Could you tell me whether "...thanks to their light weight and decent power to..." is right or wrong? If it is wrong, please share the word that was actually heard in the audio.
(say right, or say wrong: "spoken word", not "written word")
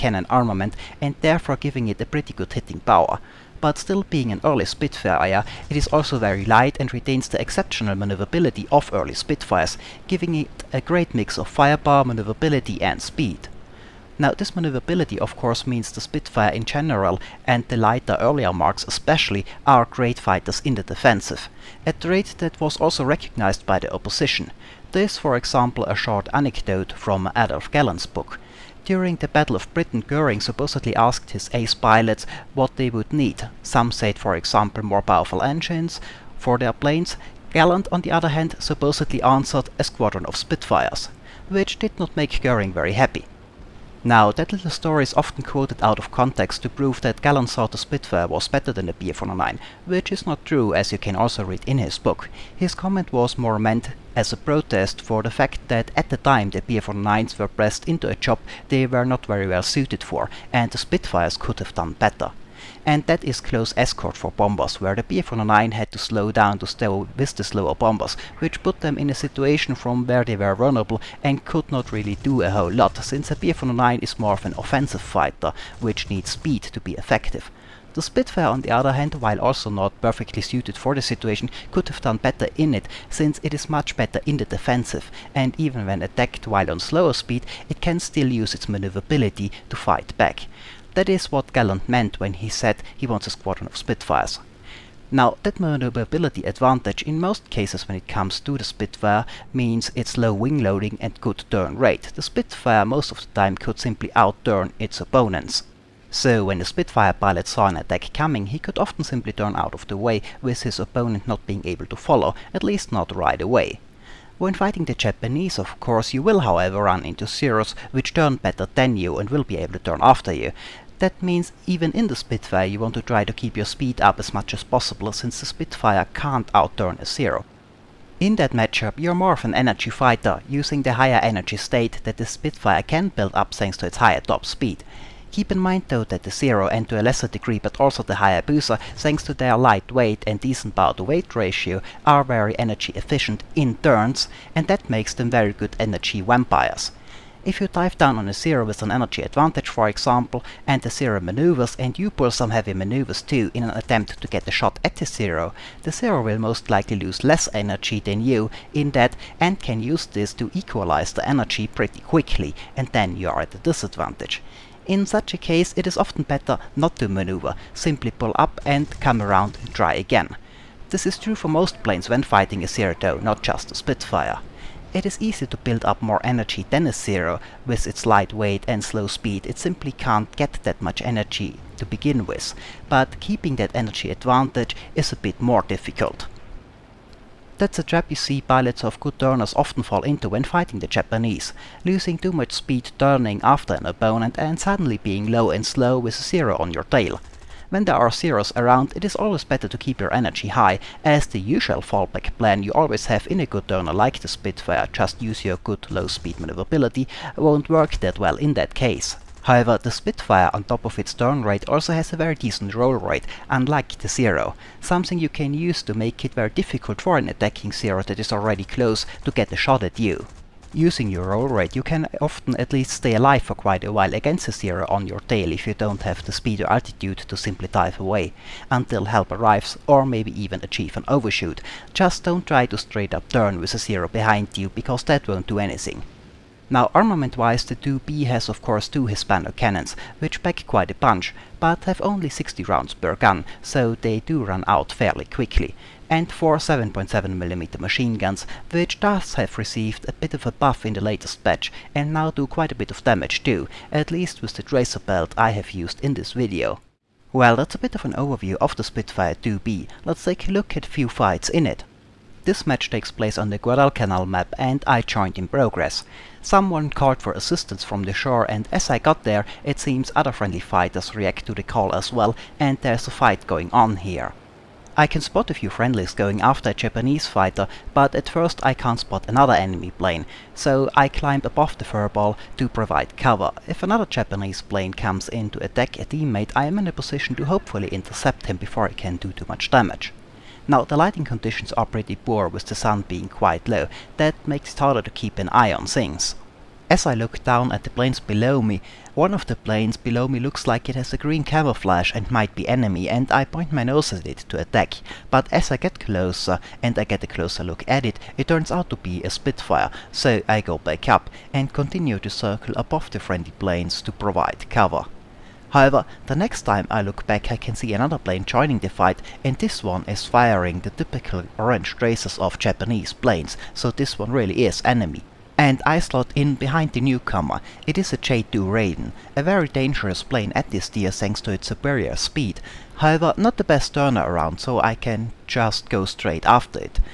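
right.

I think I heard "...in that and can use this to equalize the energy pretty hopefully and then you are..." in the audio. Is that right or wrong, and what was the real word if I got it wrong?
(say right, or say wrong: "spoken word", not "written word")
wrong: "quickly", not "hopefully".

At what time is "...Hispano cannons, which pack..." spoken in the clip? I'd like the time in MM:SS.
03:59.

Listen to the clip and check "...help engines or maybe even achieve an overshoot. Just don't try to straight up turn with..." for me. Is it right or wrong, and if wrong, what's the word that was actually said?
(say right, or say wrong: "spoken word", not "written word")
wrong: "arrives", not "engines".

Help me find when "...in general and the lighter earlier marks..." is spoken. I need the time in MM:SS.
00:16.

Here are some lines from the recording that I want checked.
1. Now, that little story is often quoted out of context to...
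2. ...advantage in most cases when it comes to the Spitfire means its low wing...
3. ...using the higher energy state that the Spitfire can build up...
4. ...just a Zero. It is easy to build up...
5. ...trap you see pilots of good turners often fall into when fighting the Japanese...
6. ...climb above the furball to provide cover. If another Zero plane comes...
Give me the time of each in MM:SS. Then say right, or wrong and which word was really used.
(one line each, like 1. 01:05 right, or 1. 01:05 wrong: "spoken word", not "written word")
1. 00:44 right
2. 01:36 right
3. 02:10 right
4. 02:53 wrong: "Spitfire", not "Zero"
5. 03:07 right
6. 04:41 wrong: "Japanese", not "Zero".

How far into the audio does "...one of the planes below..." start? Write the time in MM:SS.
04:59.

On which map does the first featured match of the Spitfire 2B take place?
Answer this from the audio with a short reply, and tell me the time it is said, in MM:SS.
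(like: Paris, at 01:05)
Guadalcanal, at 04:23.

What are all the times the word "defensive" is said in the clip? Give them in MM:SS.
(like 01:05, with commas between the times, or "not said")
00:20, 01:24.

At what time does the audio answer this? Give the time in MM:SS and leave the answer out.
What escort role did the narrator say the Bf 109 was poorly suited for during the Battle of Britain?
01:03.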